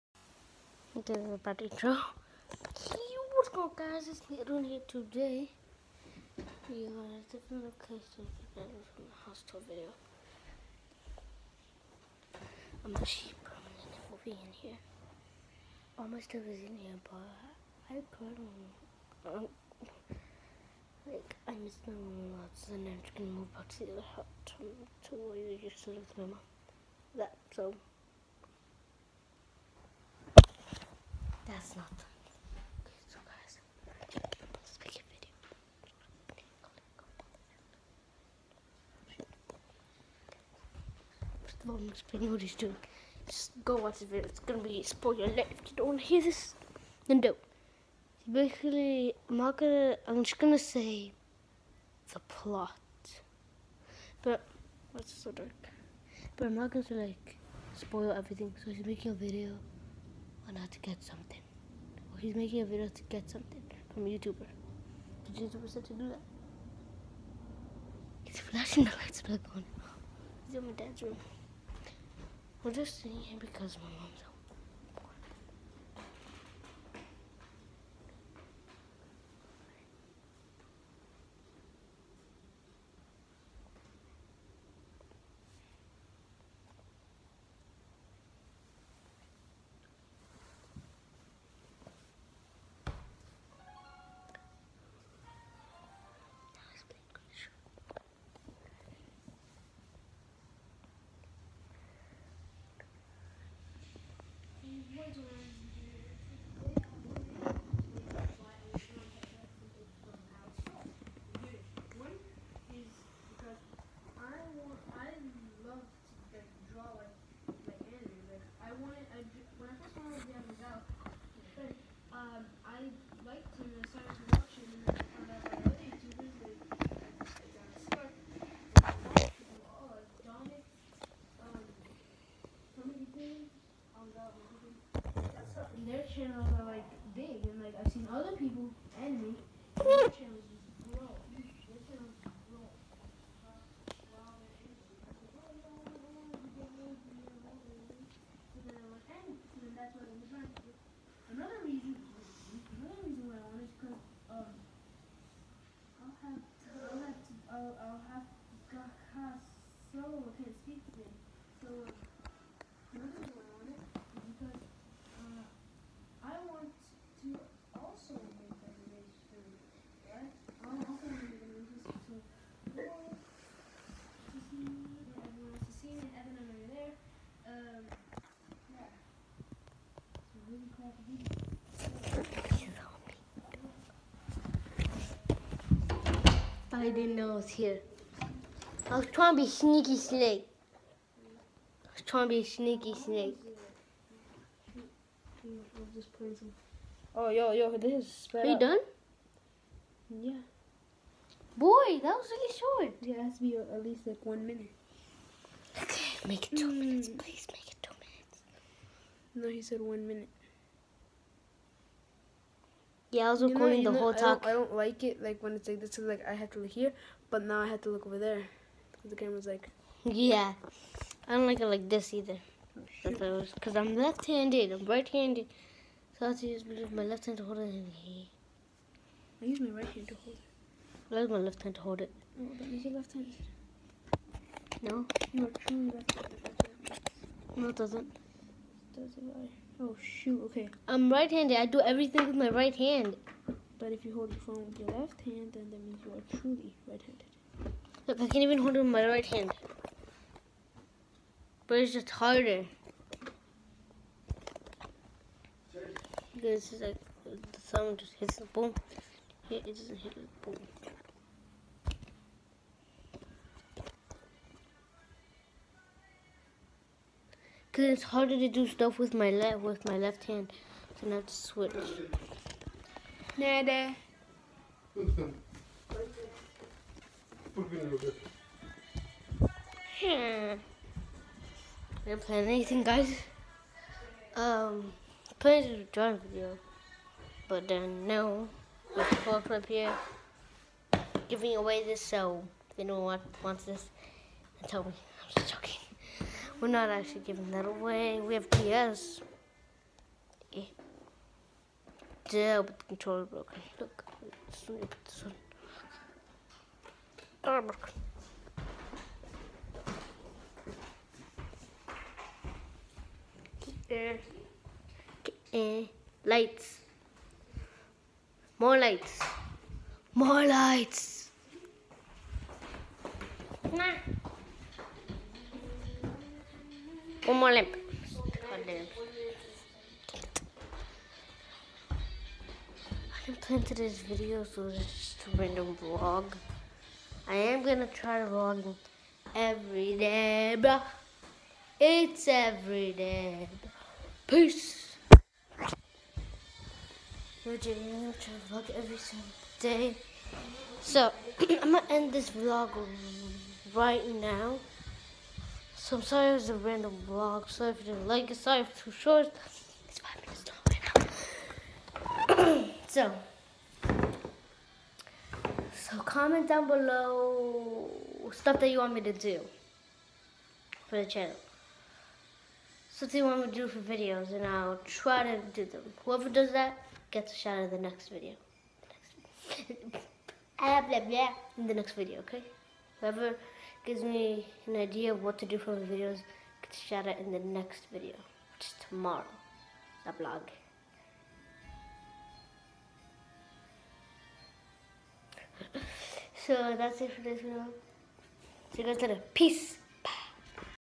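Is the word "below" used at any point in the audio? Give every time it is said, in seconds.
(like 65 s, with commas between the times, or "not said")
366 s.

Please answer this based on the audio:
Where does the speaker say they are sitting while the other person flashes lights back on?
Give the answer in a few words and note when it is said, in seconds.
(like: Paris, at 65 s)
my dad's room, at 70 s.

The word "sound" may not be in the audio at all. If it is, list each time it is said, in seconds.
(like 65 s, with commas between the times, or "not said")
257 s.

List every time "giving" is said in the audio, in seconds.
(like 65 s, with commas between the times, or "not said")
291 s, 297 s.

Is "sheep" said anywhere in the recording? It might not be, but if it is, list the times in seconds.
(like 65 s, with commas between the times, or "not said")
13 s.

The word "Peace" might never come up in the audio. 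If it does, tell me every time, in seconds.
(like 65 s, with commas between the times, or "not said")
344 s, 399 s.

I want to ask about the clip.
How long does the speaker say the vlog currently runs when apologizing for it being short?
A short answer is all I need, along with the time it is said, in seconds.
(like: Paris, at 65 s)
5 minutes, at 359 s.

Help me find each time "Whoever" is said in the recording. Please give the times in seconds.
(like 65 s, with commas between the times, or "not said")
376 s, 383 s.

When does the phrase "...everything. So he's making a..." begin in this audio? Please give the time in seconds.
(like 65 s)
58 s.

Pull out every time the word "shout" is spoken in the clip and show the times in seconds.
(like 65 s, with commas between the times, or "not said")
377 s, 386 s.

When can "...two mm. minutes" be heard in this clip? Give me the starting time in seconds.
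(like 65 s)
206 s.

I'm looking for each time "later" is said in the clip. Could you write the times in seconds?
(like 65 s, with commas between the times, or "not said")
399 s.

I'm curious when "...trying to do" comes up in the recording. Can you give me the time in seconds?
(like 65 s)
150 s.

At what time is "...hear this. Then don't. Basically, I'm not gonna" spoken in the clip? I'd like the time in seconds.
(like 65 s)
46 s.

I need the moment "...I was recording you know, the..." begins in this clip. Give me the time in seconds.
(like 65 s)
213 s.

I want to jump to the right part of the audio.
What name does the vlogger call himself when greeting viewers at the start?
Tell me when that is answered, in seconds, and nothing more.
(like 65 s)
4 s.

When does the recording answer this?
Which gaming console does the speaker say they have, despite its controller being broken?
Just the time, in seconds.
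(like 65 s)
298 s.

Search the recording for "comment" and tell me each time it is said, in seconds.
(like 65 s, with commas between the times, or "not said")
366 s.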